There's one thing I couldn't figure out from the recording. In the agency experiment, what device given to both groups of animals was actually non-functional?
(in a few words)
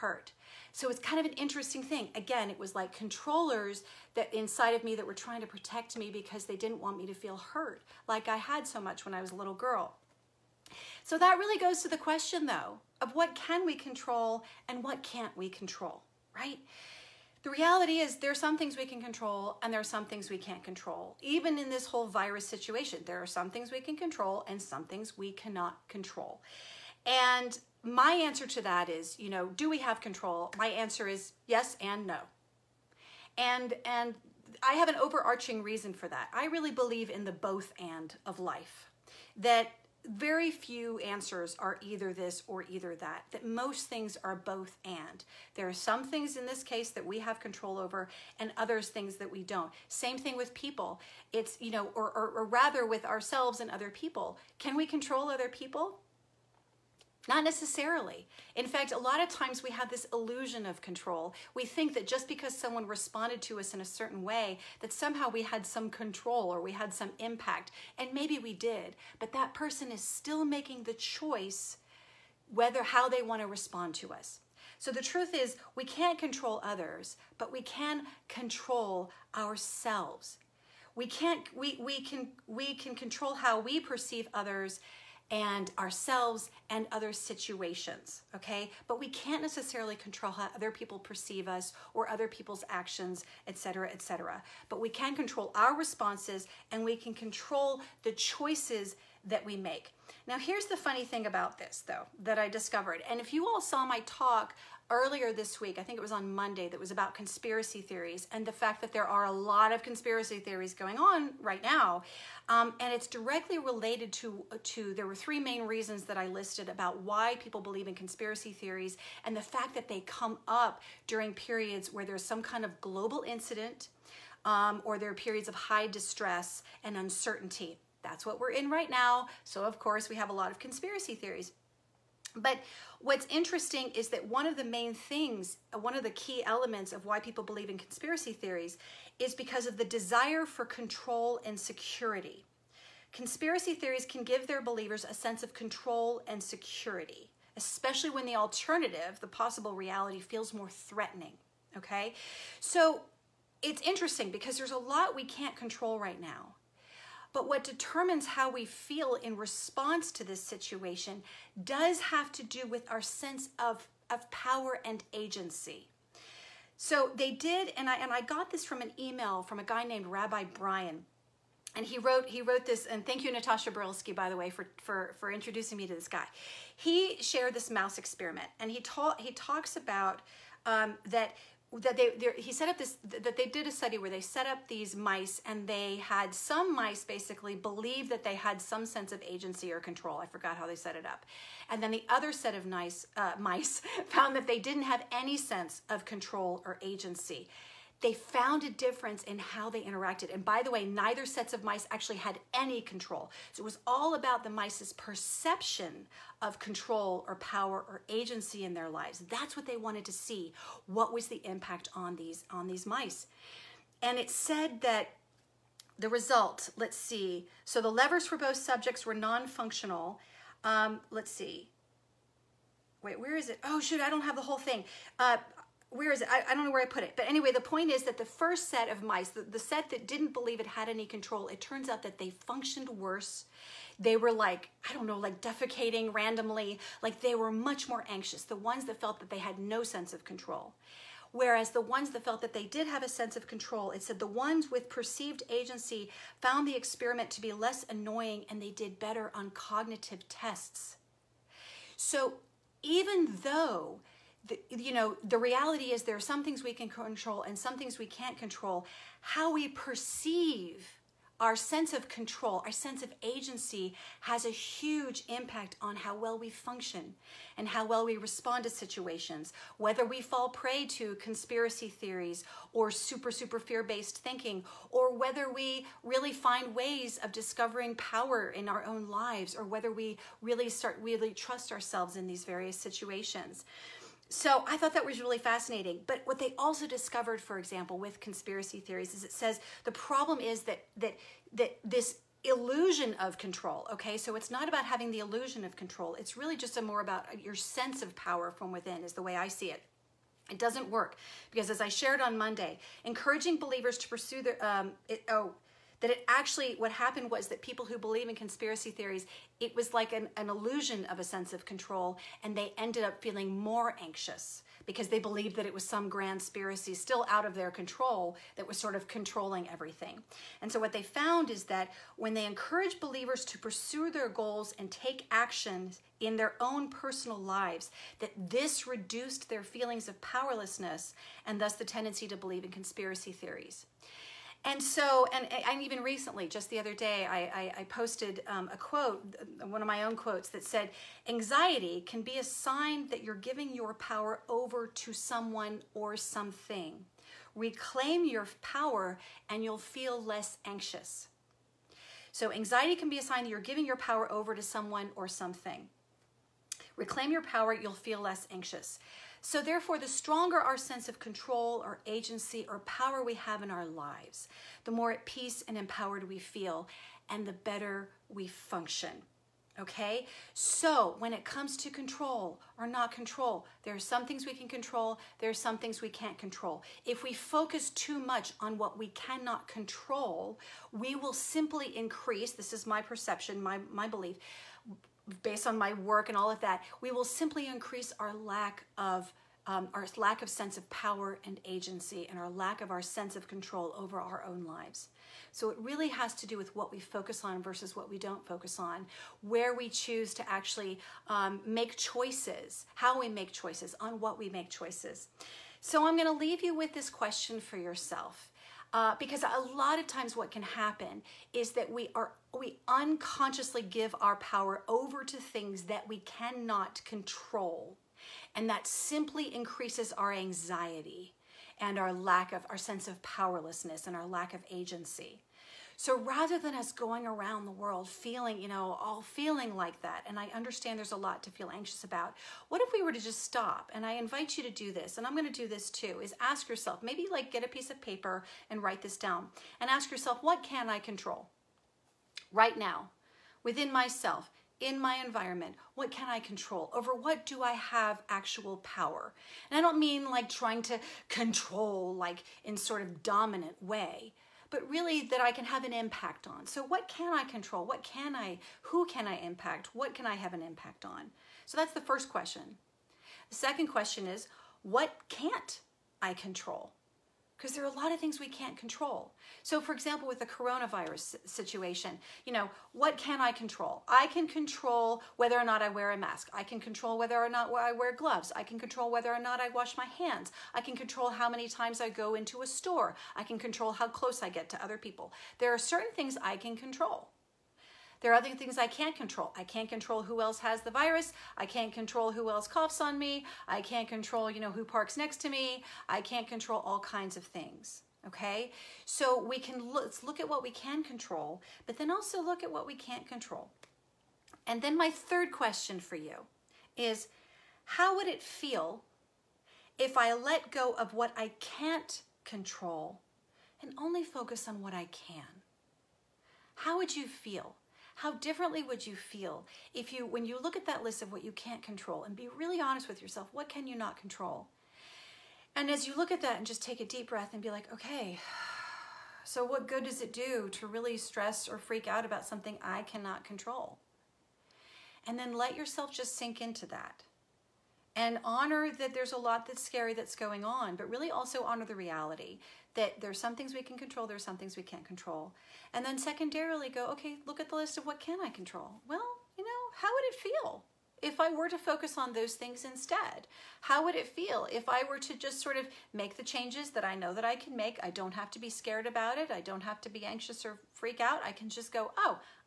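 levers.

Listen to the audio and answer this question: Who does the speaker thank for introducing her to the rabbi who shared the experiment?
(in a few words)
Natasha Berlsky.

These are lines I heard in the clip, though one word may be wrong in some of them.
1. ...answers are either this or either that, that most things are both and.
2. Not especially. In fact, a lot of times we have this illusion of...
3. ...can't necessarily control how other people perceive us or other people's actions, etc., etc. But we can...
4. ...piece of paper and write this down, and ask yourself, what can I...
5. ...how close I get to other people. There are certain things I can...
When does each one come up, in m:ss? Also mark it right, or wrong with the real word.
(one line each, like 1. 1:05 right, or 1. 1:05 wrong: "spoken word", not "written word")
1. 0:40 right
2. 0:57 wrong: "necessarily", not "especially"
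3. 1:29 right
4. 7:17 right
5. 8:03 right.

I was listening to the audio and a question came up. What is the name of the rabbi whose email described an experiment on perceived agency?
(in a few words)
Rabbi Brian.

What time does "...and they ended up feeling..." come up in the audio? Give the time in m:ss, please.
5:12.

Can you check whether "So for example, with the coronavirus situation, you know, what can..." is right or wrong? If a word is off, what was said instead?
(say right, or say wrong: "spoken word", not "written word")
right.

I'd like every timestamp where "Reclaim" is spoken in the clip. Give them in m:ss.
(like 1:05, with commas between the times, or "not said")
5:47, 5:56.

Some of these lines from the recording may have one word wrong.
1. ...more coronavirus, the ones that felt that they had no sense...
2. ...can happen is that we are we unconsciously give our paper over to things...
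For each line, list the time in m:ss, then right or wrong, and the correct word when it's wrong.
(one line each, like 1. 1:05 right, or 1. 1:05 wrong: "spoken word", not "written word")
1. 3:57 wrong: "anxious", not "coronavirus"
2. 6:50 wrong: "power", not "paper".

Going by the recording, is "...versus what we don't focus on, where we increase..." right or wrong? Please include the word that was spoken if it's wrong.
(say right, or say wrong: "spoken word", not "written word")
wrong: "choose", not "increase".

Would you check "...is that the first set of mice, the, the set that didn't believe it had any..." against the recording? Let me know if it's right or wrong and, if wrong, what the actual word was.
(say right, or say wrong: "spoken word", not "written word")
right.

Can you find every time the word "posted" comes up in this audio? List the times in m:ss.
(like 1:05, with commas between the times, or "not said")
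5:37.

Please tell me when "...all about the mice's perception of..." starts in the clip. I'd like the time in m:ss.
3:23.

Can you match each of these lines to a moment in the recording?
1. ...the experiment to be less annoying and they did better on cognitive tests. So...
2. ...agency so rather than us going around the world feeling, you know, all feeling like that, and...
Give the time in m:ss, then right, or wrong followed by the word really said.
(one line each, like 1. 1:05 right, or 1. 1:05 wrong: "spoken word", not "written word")
1. 4:06 right
2. 7:04 right.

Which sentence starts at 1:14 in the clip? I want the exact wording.
So the truth is, we can't control others, but we can control ourselves.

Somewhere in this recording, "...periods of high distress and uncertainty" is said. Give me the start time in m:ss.
2:05.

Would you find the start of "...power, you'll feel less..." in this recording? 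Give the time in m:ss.
5:57.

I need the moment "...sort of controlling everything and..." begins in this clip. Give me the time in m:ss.
5:18.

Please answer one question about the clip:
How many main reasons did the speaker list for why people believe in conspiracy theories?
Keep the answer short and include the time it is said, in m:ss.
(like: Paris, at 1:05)
3, at 1:55.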